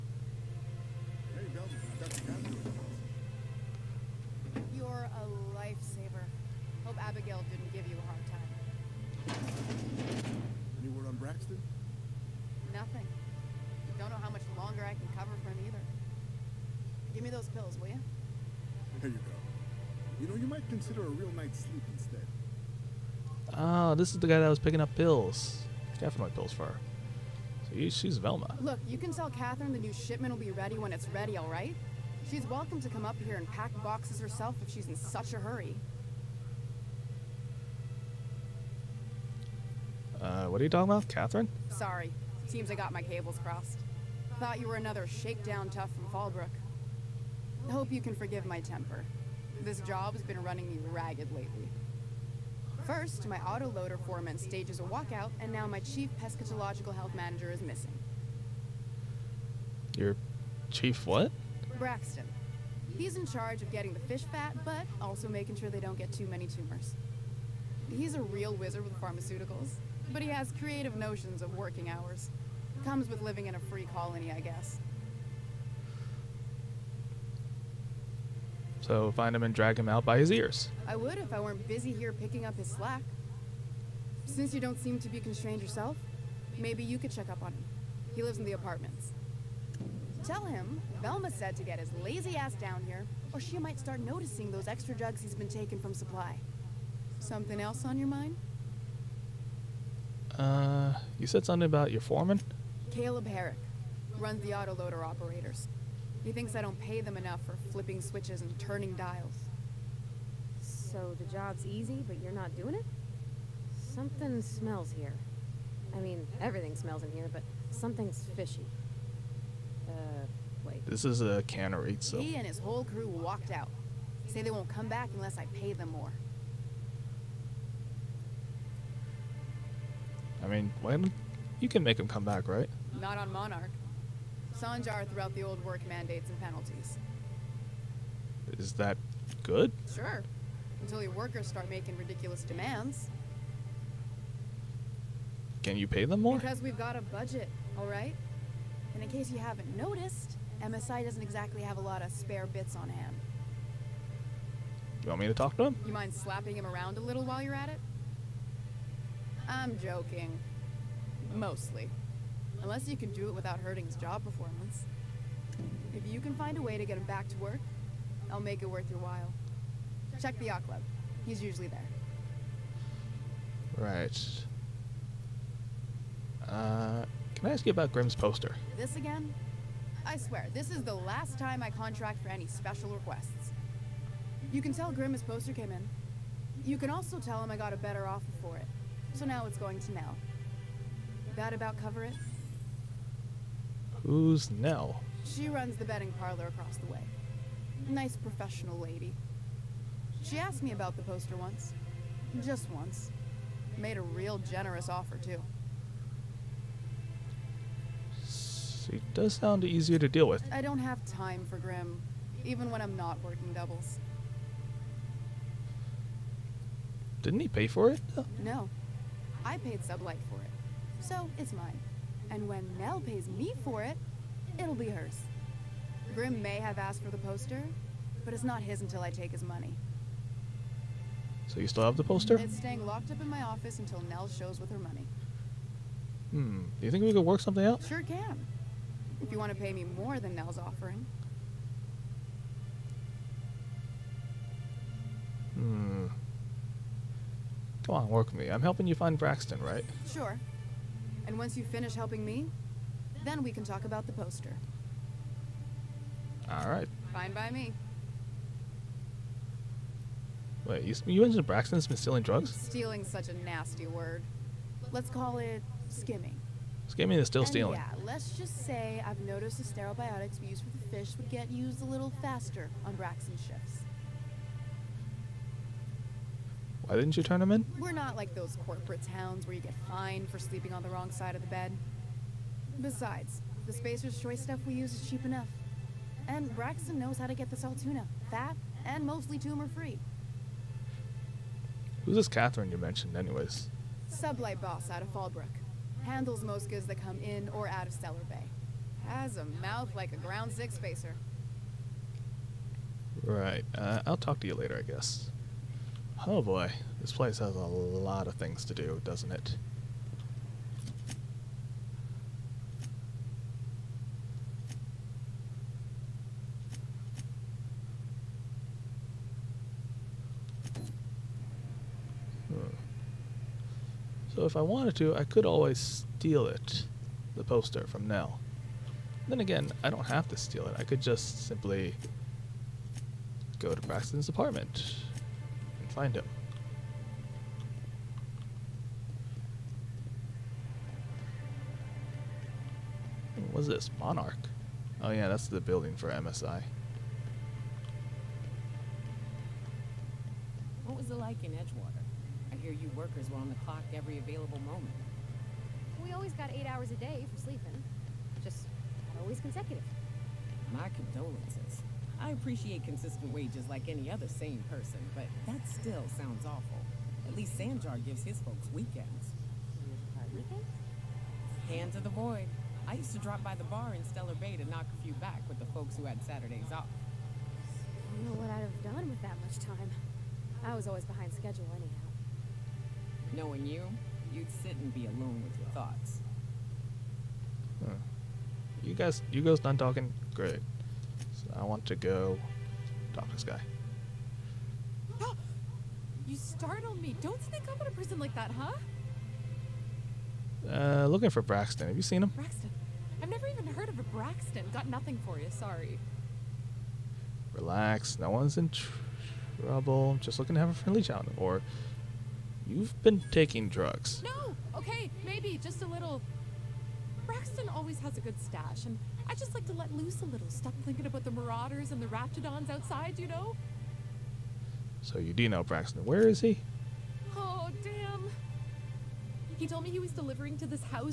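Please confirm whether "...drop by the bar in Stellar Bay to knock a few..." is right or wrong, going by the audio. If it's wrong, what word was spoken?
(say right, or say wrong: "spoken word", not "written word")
right.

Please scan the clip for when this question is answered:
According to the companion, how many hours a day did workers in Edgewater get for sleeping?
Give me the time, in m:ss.
5:56.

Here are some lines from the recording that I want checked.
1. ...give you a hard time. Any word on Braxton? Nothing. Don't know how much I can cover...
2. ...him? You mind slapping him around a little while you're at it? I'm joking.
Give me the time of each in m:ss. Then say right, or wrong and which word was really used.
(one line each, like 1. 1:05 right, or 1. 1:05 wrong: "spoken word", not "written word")
1. 0:07 right
2. 2:35 right.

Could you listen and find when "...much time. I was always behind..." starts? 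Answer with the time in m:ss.
6:19.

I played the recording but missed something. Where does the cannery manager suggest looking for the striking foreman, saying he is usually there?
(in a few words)
The yacht club.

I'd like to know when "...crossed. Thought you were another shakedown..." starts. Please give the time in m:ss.
0:43.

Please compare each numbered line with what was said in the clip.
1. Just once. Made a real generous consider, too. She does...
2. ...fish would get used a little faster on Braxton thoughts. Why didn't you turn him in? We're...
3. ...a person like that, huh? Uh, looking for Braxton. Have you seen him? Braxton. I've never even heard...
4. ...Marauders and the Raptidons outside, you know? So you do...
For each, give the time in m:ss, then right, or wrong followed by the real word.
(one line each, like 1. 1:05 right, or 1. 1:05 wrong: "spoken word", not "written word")
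1. 3:22 wrong: "offer", not "consider"
2. 4:30 wrong: "shifts", not "thoughts"
3. 6:37 right
4. 7:01 right.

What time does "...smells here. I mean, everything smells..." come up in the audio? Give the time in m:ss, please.
1:54.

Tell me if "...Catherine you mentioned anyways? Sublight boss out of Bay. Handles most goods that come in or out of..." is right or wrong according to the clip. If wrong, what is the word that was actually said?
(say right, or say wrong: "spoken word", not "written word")
wrong: "Fallbrook", not "Bay".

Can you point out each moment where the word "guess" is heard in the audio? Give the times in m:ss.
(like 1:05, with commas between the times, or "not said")
1:14, 5:04.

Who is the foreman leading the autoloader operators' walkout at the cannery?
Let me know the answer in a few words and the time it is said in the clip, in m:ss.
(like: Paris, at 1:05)
Caleb Herrick, at 1:42.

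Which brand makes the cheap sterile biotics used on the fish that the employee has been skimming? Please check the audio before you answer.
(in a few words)
Spacer's Choice.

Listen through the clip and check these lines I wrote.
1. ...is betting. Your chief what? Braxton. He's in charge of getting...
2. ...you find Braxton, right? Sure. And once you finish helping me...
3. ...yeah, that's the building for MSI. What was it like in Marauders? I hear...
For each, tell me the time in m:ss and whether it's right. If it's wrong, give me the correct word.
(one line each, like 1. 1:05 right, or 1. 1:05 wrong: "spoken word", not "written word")
1. 0:57 wrong: "missing", not "betting"
2. 4:08 right
3. 5:45 wrong: "Edgewater", not "Marauders".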